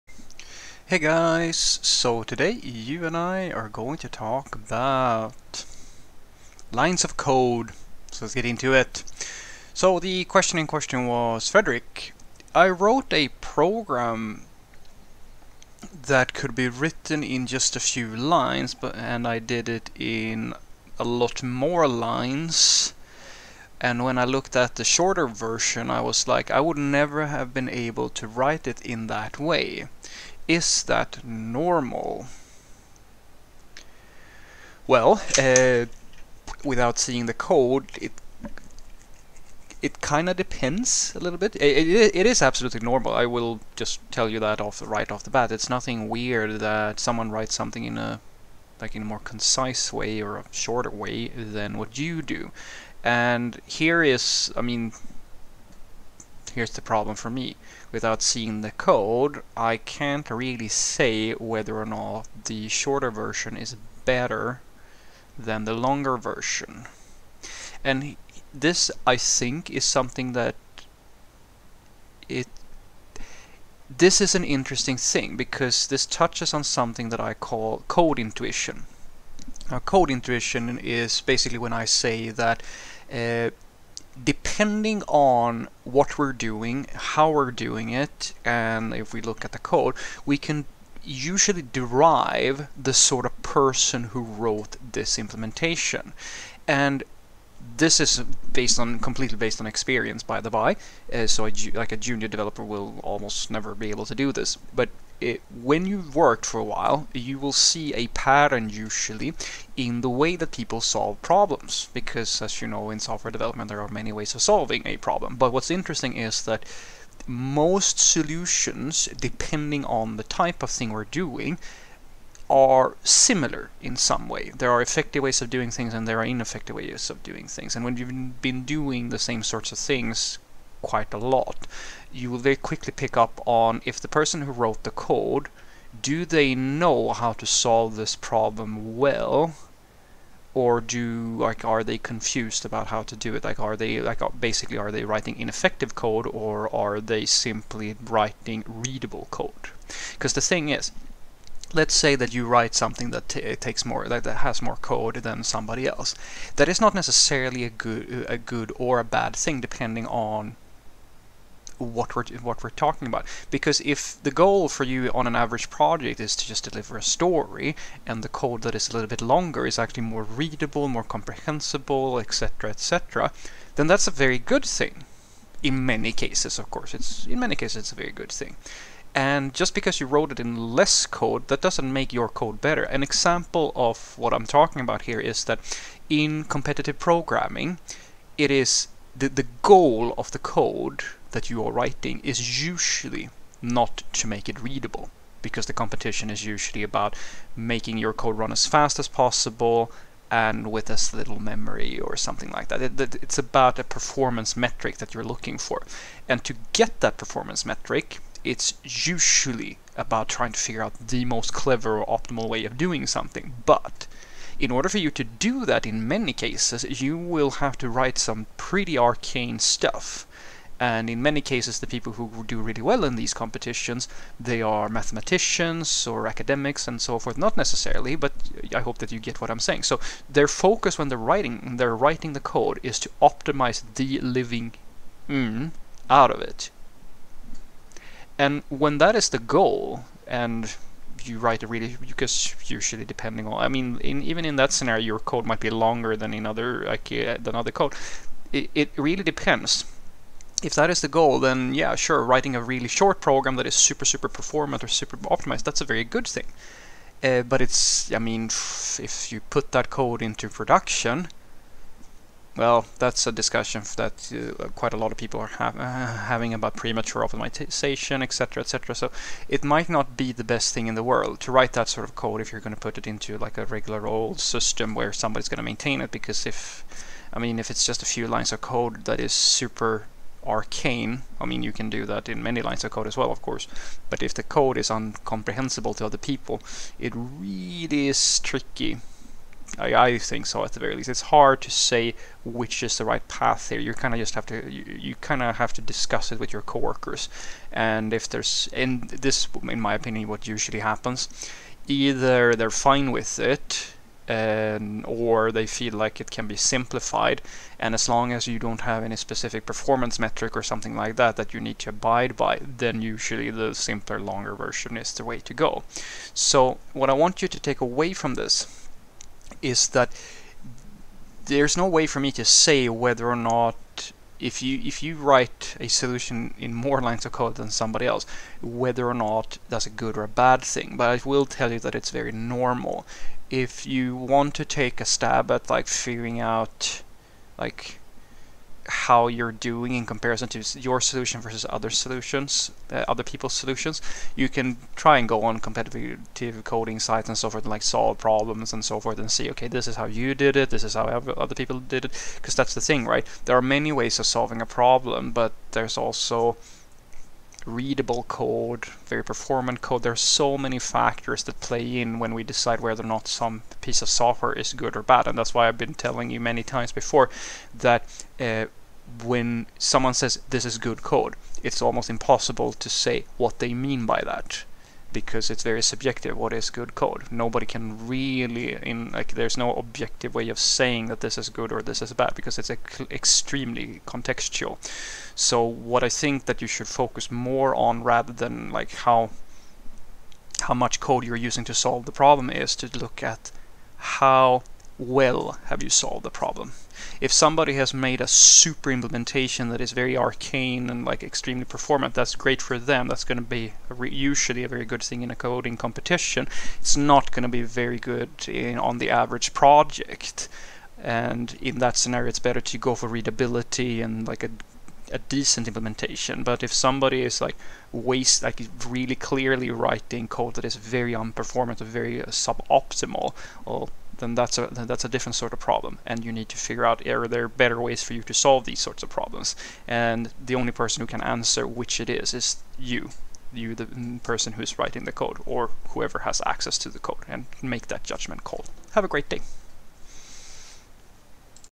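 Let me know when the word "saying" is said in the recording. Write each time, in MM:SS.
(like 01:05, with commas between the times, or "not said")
03:49, 06:20.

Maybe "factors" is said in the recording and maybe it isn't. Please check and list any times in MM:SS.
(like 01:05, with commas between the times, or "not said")
06:00.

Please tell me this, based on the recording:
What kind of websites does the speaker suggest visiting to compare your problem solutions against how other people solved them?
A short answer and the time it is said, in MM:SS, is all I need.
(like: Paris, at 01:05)
Competitive coding sites, at 05:45.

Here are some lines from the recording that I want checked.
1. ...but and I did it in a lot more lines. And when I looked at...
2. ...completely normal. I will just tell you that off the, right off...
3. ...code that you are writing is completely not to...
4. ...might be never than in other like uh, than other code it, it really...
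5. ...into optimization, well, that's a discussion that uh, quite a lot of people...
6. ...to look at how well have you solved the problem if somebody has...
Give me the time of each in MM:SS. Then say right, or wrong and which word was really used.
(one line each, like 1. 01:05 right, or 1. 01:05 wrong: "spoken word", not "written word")
1. 00:18 right
2. 00:42 wrong: "absolutely", not "completely"
3. 03:10 wrong: "usually", not "completely"
4. 04:05 wrong: "longer", not "never"
5. 04:20 wrong: "production", not "optimization"
6. 06:32 right.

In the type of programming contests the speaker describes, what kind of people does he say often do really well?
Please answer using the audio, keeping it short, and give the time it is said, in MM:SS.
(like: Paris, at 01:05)
Mathematicians or academics, at 03:44.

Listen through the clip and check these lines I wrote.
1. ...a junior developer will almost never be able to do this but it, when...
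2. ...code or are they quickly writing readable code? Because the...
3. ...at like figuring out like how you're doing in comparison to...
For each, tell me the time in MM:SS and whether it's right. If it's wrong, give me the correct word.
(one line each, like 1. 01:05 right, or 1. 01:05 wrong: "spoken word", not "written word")
1. 01:41 right
2. 02:25 wrong: "simply", not "quickly"
3. 05:35 right.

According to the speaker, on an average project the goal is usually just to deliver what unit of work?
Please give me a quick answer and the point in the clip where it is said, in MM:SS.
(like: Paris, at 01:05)
A story, at 02:46.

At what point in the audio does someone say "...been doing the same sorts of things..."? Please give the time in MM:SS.
02:08.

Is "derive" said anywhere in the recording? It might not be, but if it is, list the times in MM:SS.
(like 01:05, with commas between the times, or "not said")
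01:31.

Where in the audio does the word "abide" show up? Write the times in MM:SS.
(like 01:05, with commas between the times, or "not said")
05:11.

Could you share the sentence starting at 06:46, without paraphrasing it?
It's not going to be very good in, on the average project.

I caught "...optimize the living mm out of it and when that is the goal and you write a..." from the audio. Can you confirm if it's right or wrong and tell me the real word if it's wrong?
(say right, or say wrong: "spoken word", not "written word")
right.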